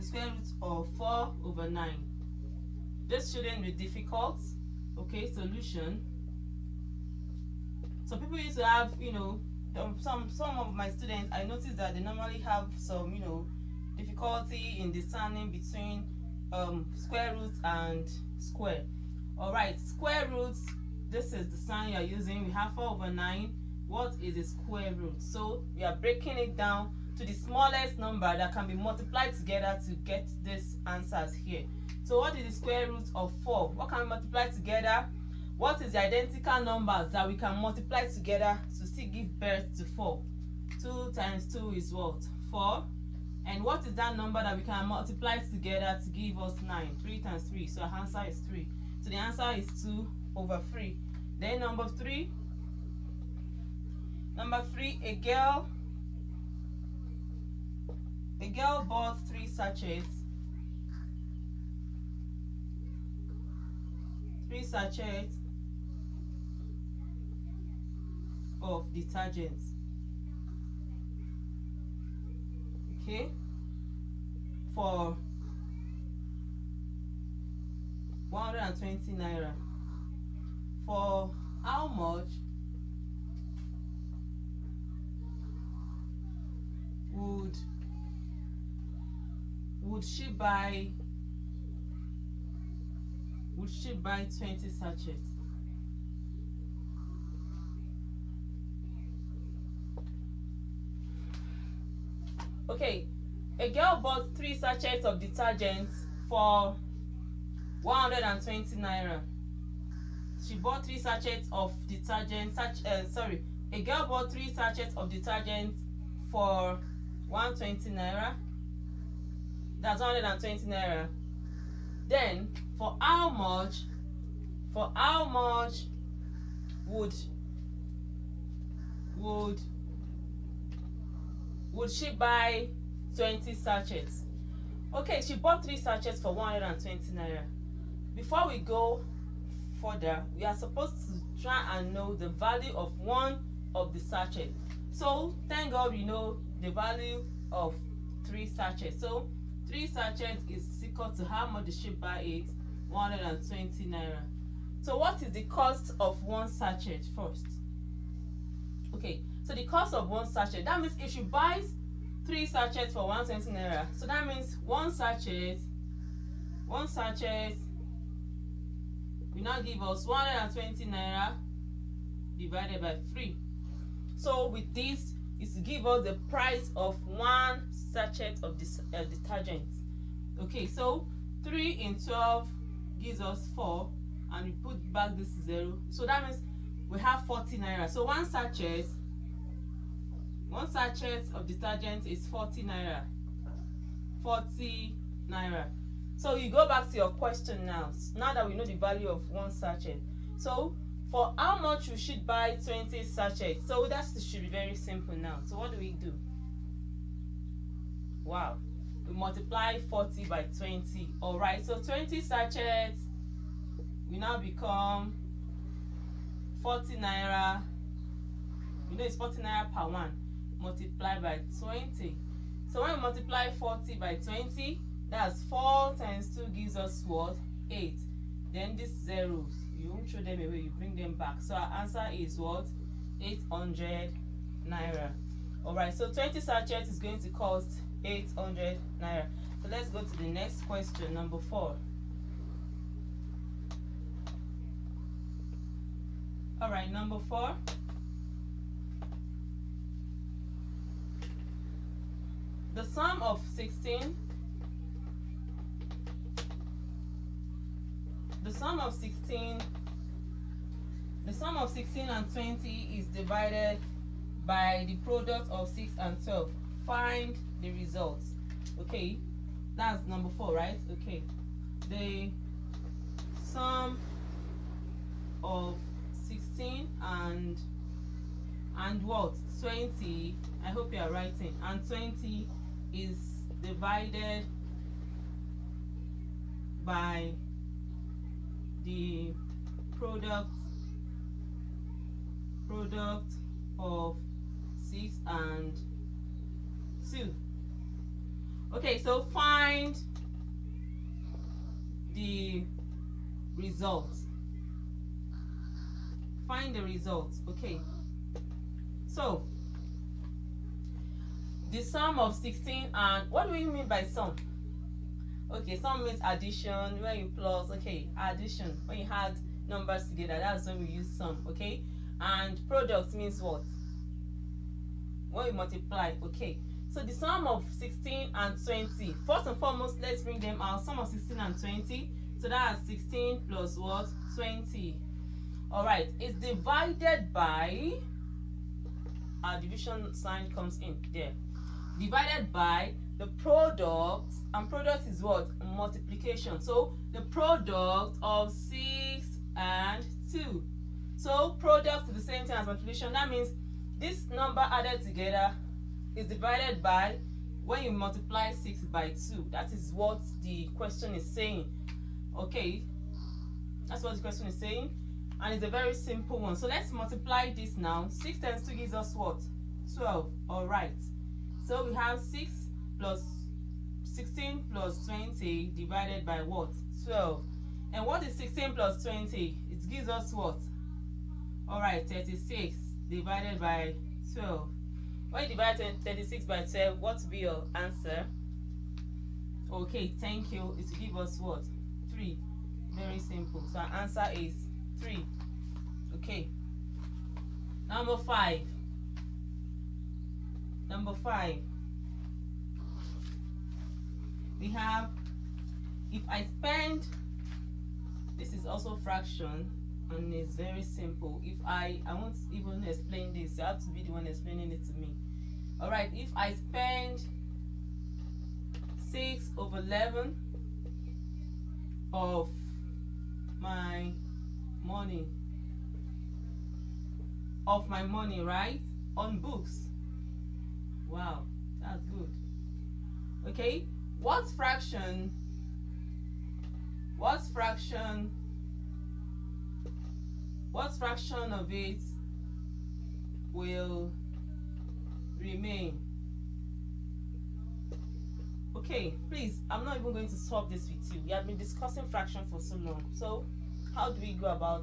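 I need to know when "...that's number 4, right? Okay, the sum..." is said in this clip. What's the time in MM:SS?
04:29.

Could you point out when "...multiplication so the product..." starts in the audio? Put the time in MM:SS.
05:45.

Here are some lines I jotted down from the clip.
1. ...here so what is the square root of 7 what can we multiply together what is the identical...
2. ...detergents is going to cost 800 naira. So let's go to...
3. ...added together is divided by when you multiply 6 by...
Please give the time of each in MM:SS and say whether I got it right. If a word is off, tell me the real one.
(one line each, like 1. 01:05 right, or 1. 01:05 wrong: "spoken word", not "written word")
1. 00:31 wrong: "4", not "7"
2. 03:56 wrong: "sachets", not "detergents"
3. 05:54 right.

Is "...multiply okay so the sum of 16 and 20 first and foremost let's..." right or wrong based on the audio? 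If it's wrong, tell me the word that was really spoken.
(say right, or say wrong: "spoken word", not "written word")
right.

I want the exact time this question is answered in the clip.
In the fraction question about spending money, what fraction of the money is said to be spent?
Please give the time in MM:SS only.
06:59.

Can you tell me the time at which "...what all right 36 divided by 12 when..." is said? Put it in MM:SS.
06:20.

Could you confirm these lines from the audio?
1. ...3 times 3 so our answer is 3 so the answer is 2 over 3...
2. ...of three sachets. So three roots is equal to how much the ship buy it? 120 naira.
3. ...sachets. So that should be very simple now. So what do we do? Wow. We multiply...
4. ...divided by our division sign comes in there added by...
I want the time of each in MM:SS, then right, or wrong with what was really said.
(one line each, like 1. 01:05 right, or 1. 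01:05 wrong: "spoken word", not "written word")
1. 00:46 right
2. 02:27 wrong: "sachets", not "roots"
3. 03:23 right
4. 05:36 wrong: "divided", not "added".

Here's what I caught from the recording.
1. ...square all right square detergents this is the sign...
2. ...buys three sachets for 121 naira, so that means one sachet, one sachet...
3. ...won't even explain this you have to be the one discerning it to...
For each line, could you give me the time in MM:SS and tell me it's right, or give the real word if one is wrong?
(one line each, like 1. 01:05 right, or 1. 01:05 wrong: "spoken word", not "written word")
1. 00:18 wrong: "roots", not "detergents"
2. 02:41 wrong: "120", not "121"
3. 06:52 wrong: "explaining", not "discerning".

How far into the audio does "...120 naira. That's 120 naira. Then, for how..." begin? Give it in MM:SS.
01:57.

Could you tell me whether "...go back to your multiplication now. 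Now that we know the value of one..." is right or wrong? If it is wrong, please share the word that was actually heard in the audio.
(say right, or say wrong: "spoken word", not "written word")
wrong: "question", not "multiplication".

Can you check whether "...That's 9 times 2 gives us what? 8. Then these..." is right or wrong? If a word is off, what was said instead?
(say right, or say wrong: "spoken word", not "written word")
wrong: "4", not "9".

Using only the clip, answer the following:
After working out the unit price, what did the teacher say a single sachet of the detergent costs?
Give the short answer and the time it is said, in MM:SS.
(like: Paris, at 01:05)
40 naira, at 03:05.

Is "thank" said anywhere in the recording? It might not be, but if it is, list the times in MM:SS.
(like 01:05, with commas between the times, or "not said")
02:25, 06:30.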